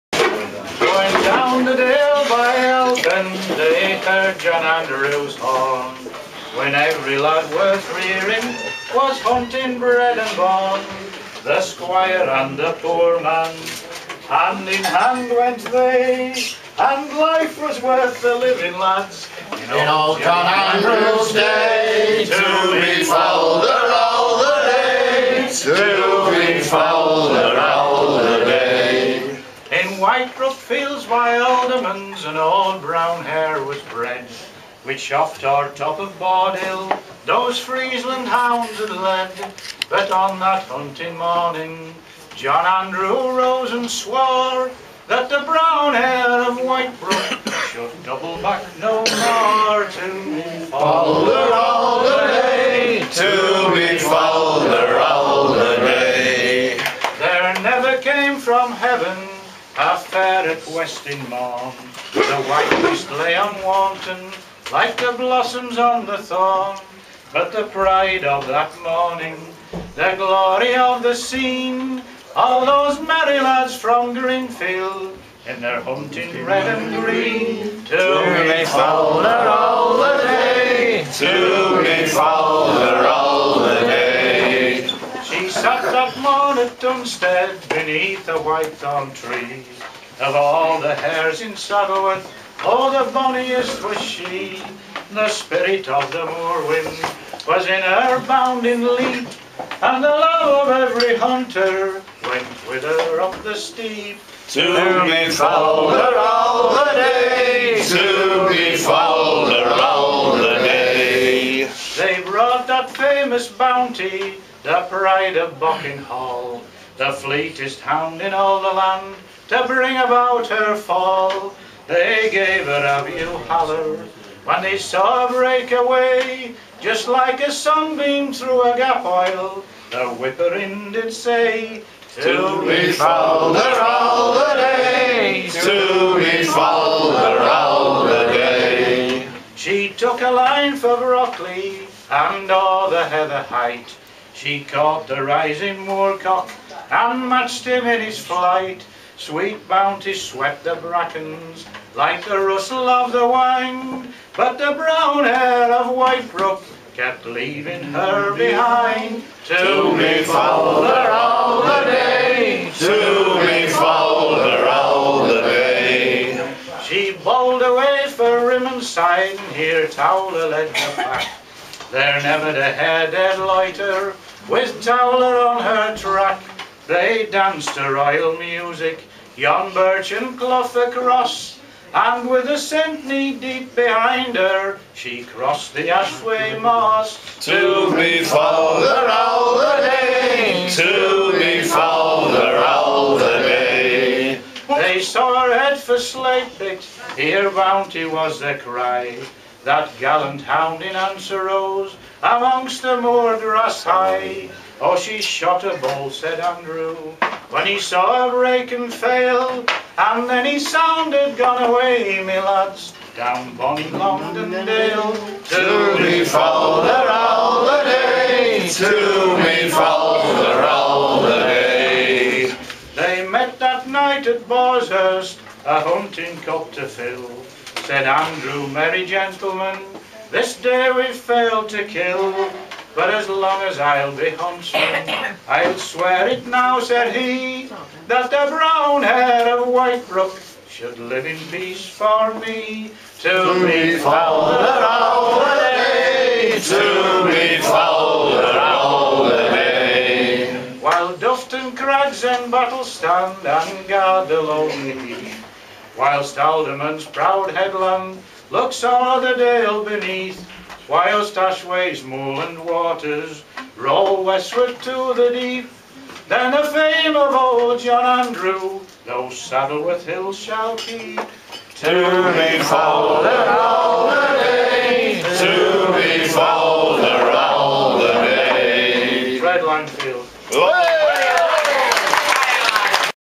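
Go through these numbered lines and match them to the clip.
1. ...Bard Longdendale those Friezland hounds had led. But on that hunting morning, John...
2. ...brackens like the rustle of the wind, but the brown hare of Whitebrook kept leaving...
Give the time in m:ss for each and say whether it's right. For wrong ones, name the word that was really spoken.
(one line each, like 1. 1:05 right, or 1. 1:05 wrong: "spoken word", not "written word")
1. 0:36 wrong: "Hill", not "Longdendale"
2. 2:30 right.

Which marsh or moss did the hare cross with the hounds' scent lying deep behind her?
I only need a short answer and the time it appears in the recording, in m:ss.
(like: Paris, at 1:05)
Ashway Moss, at 3:05.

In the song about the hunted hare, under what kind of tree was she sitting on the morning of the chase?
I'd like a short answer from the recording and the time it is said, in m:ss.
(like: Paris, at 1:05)
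white thorn tree, at 1:28.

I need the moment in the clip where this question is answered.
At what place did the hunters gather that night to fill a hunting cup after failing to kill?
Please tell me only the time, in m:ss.
3:44.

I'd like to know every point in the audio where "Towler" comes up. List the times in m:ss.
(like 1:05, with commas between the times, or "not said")
2:49, 2:54.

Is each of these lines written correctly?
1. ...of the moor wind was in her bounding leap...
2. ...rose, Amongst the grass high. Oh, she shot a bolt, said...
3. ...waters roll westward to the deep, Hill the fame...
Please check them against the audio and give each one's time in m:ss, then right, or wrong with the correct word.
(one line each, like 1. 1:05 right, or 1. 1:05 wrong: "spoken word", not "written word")
1. 1:35 right
2. 3:21 right
3. 4:22 wrong: "Then", not "Hill".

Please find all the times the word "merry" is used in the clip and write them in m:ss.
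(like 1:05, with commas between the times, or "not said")
1:13, 3:48.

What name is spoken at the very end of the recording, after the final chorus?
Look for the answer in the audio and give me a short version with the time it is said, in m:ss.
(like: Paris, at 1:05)
Fred Langfield, at 4:39.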